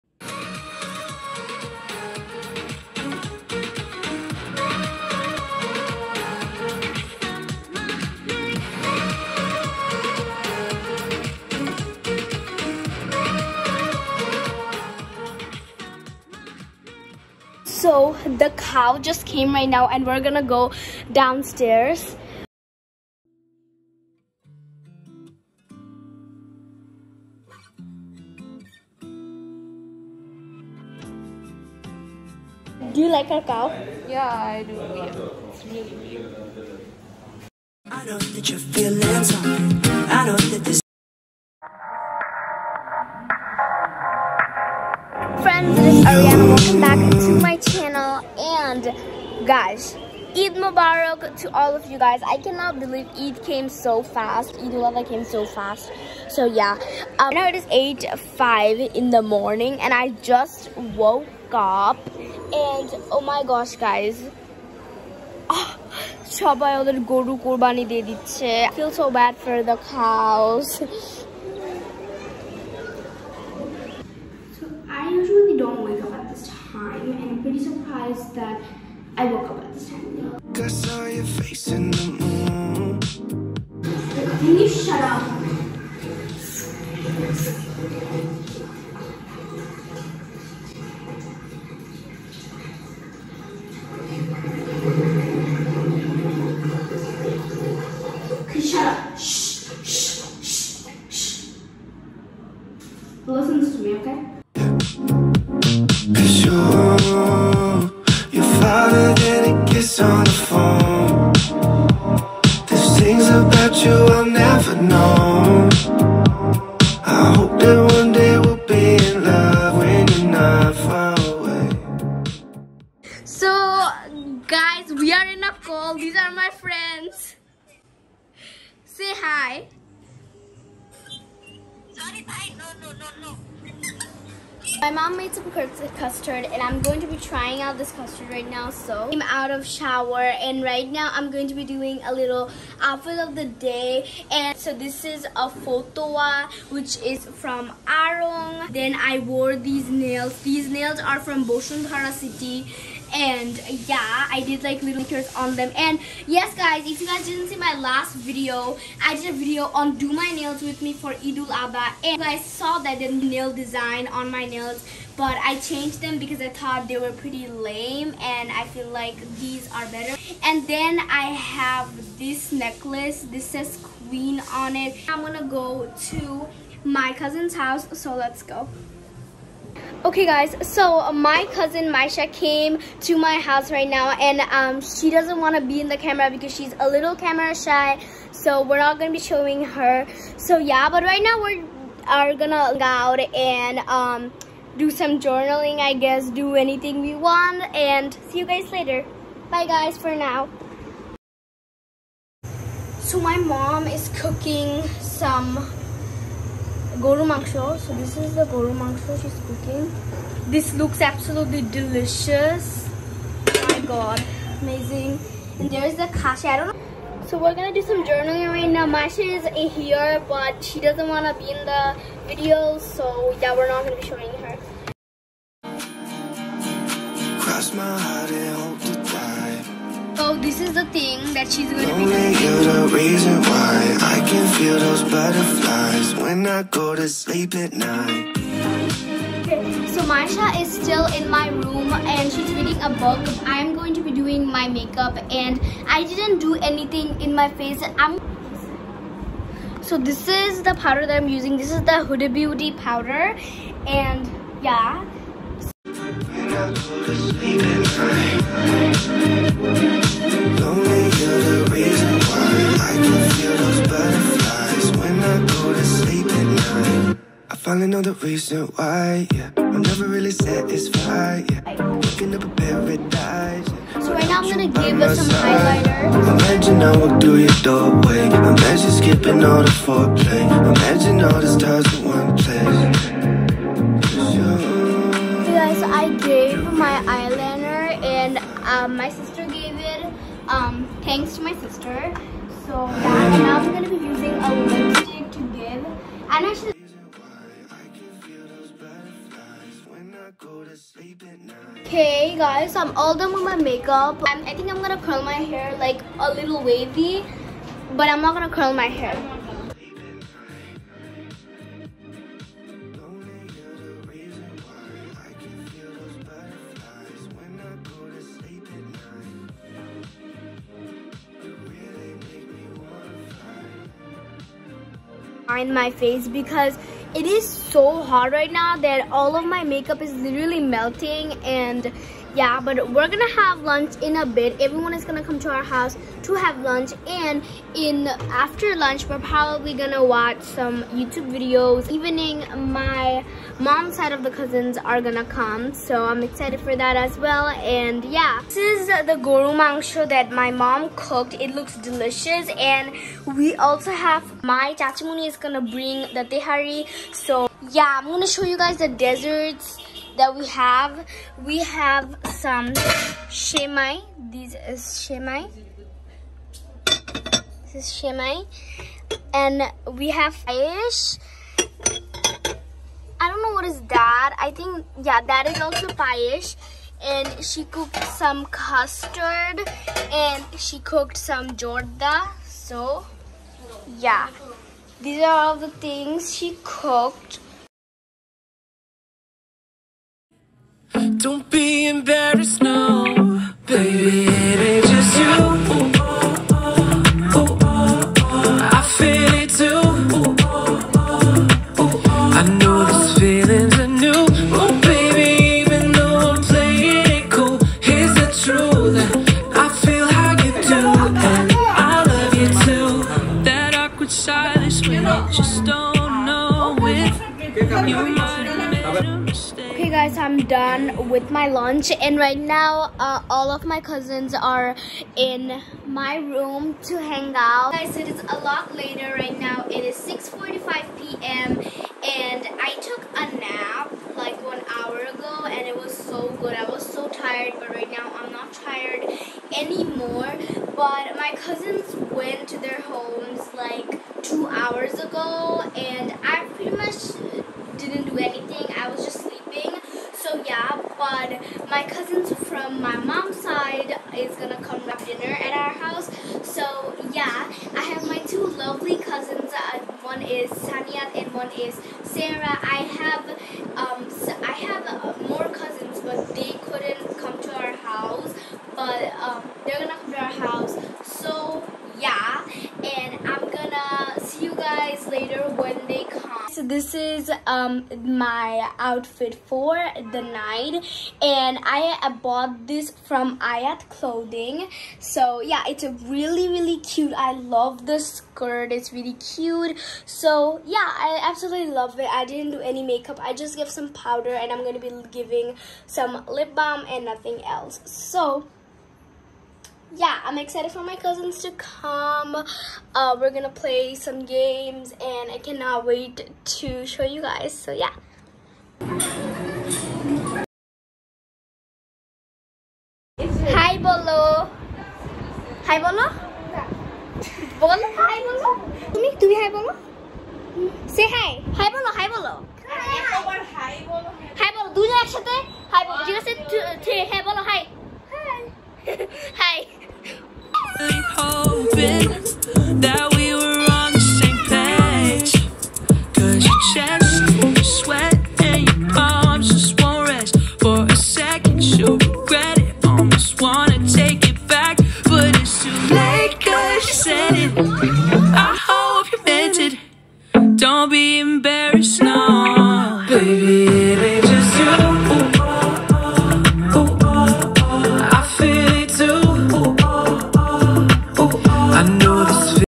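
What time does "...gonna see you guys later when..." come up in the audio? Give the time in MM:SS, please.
07:53.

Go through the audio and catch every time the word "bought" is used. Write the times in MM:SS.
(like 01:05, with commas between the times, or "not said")
08:02.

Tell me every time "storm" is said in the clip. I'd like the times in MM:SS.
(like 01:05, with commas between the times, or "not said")
not said.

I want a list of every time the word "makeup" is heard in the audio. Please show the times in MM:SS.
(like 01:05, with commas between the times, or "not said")
04:04, 05:03, 05:29, 08:12.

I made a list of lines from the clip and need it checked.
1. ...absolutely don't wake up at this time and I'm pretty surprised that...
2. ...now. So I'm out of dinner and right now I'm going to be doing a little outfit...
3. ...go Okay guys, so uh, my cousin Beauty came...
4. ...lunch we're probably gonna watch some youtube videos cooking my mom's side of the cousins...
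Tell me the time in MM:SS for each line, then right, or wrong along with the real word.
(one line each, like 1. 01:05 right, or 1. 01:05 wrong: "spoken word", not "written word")
1. 01:15 wrong: "usually", not "absolutely"
2. 02:18 wrong: "shower", not "dinner"
3. 02:58 wrong: "Maisha", not "Beauty"
4. 05:38 wrong: "evening", not "cooking".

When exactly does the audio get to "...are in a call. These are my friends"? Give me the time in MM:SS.
02:05.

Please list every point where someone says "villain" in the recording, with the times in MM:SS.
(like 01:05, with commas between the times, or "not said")
not said.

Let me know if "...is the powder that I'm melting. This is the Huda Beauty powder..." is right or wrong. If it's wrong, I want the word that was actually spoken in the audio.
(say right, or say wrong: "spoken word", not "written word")
wrong: "using", not "melting".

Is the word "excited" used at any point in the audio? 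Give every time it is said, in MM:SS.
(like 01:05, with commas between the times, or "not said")
05:46, 08:20.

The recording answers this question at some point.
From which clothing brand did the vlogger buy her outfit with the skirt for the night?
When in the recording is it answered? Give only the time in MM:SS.
08:03.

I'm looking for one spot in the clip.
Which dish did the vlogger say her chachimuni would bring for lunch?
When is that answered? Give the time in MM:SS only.
05:56.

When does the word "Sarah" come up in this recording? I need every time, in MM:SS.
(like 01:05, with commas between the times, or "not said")
07:42.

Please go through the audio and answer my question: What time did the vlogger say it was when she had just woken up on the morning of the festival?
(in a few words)
8:05.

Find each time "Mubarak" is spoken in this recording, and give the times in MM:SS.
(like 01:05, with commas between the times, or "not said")
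00:50.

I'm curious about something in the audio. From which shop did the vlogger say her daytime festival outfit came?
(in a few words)
Aarong.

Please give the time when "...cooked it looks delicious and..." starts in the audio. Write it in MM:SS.
05:50.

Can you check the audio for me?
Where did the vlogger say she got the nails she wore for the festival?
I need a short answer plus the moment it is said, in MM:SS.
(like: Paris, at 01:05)
Bashundhara City, at 02:31.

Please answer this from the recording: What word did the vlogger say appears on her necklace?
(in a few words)
queen.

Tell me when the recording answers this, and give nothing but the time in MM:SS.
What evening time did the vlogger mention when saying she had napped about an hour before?
07:09.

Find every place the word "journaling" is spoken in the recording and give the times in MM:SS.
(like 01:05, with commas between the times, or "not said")
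03:15, 03:38.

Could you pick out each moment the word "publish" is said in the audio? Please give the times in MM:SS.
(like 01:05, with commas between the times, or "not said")
not said.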